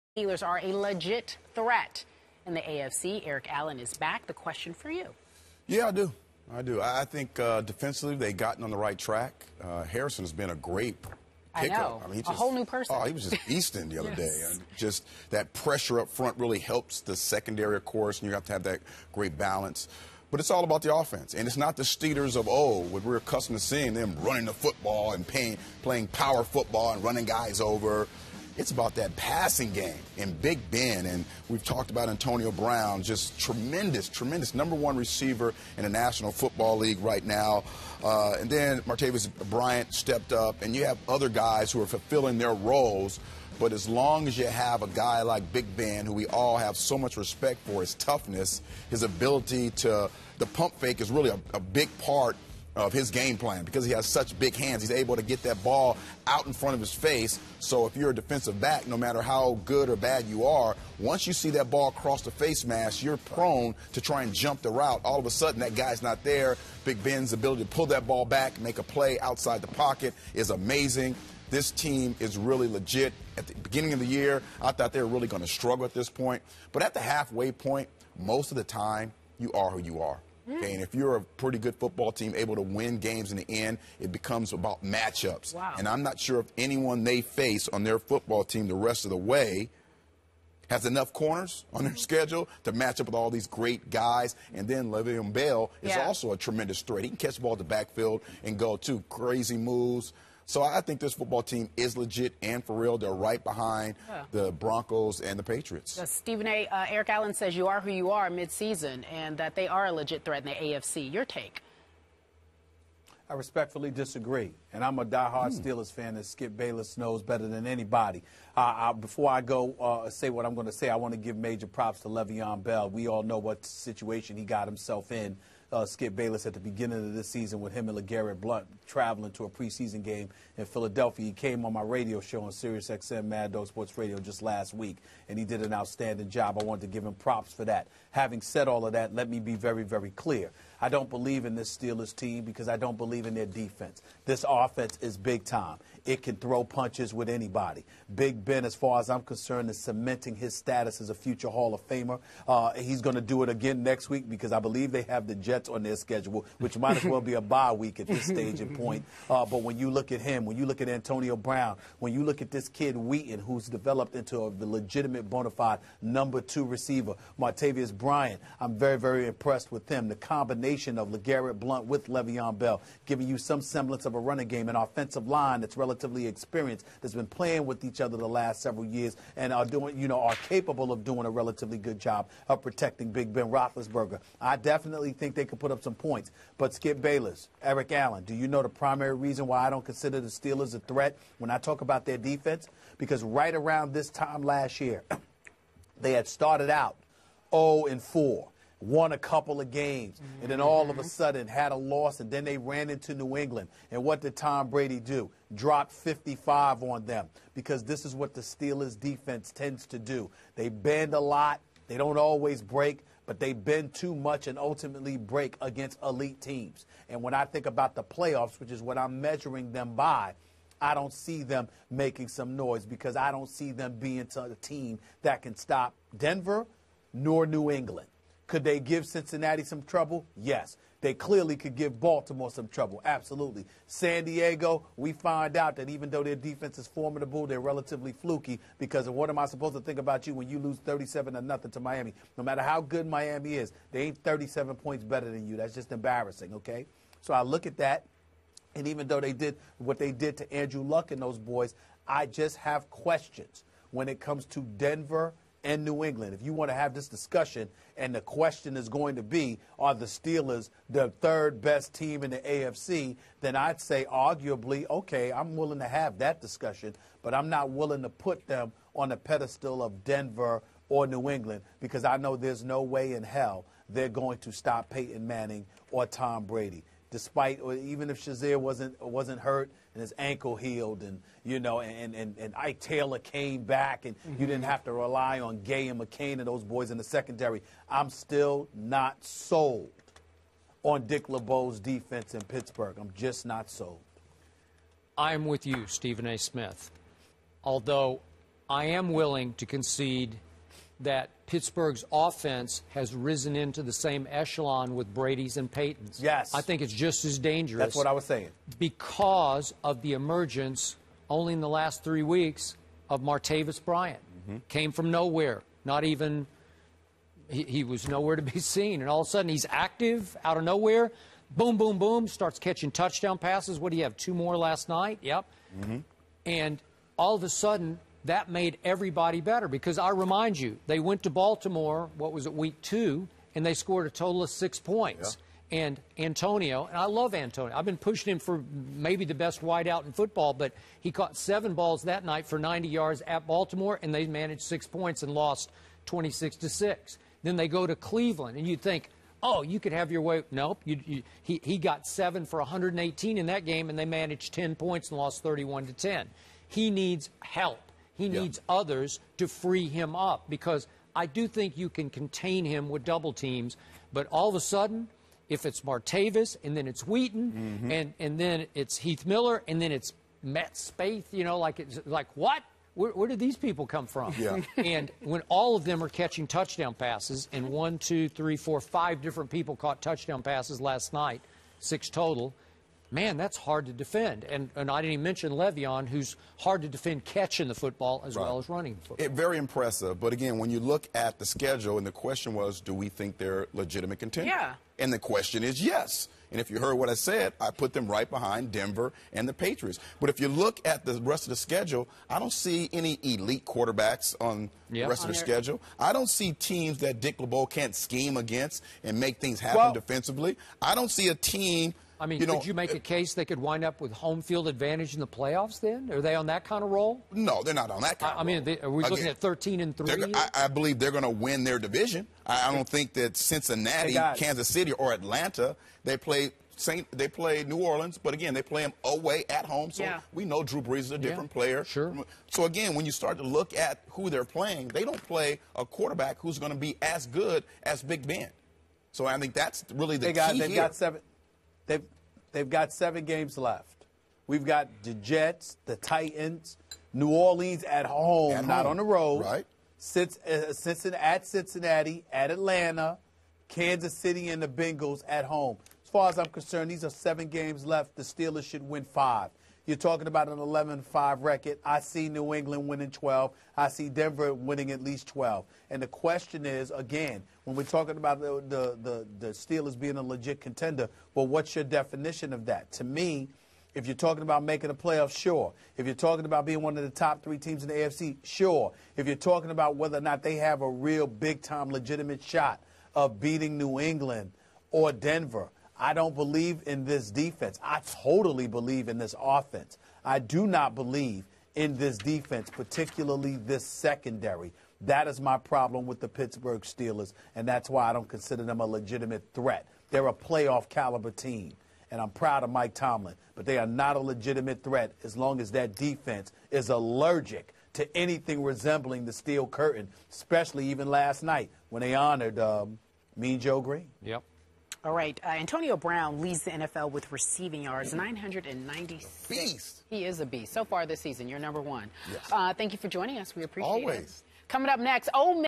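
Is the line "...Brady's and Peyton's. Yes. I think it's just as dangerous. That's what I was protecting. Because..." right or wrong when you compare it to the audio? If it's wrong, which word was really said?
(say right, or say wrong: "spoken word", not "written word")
wrong: "saying", not "protecting".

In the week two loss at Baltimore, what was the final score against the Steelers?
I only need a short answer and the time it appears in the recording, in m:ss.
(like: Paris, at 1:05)
26 to 6, at 5:46.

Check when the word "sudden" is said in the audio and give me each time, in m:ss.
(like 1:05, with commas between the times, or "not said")
1:05, 3:21, 5:19, 5:27, 6:04.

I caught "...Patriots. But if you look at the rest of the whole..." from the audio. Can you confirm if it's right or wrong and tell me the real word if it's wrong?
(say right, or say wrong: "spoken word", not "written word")
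wrong: "schedule", not "whole".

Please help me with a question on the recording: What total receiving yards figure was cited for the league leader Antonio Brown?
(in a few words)
996.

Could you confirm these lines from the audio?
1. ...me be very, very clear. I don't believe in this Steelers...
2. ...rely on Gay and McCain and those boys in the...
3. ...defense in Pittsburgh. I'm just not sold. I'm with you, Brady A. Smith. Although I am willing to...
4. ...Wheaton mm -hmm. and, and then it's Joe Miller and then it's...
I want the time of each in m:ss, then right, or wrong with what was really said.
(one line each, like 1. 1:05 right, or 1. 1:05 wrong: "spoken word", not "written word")
1. 2:19 right
2. 4:44 right
3. 4:51 wrong: "Stephen", not "Brady"
4. 6:07 wrong: "Heath", not "Joe".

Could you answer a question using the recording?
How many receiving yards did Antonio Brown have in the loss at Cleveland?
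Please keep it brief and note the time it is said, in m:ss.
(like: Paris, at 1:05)
118, at 5:52.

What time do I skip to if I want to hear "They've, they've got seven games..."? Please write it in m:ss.
7:21.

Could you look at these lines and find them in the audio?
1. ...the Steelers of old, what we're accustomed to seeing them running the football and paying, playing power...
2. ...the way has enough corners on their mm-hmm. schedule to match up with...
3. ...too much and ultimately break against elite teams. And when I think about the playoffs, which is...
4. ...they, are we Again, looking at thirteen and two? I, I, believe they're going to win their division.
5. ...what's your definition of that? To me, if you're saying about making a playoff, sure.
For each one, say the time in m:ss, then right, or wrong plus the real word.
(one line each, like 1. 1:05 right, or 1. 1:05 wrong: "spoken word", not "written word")
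1. 0:21 right
2. 1:29 right
3. 3:33 right
4. 6:58 wrong: "three", not "two"
5. 7:51 wrong: "talking", not "saying".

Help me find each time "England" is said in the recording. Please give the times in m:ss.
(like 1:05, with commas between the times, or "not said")
3:23, 3:47, 4:16, 4:31, 7:42, 8:03.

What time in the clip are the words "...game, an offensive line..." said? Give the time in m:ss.
2:54.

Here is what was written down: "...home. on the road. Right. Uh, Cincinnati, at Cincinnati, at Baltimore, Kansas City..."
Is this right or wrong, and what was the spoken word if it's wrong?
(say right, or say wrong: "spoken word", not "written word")
wrong: "Atlanta", not "Baltimore".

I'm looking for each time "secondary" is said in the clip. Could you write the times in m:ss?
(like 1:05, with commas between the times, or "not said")
0:17, 4:47, 8:13.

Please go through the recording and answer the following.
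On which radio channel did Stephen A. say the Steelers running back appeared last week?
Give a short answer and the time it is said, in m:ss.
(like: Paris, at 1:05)
Mad Dog Sports Radio, at 2:13.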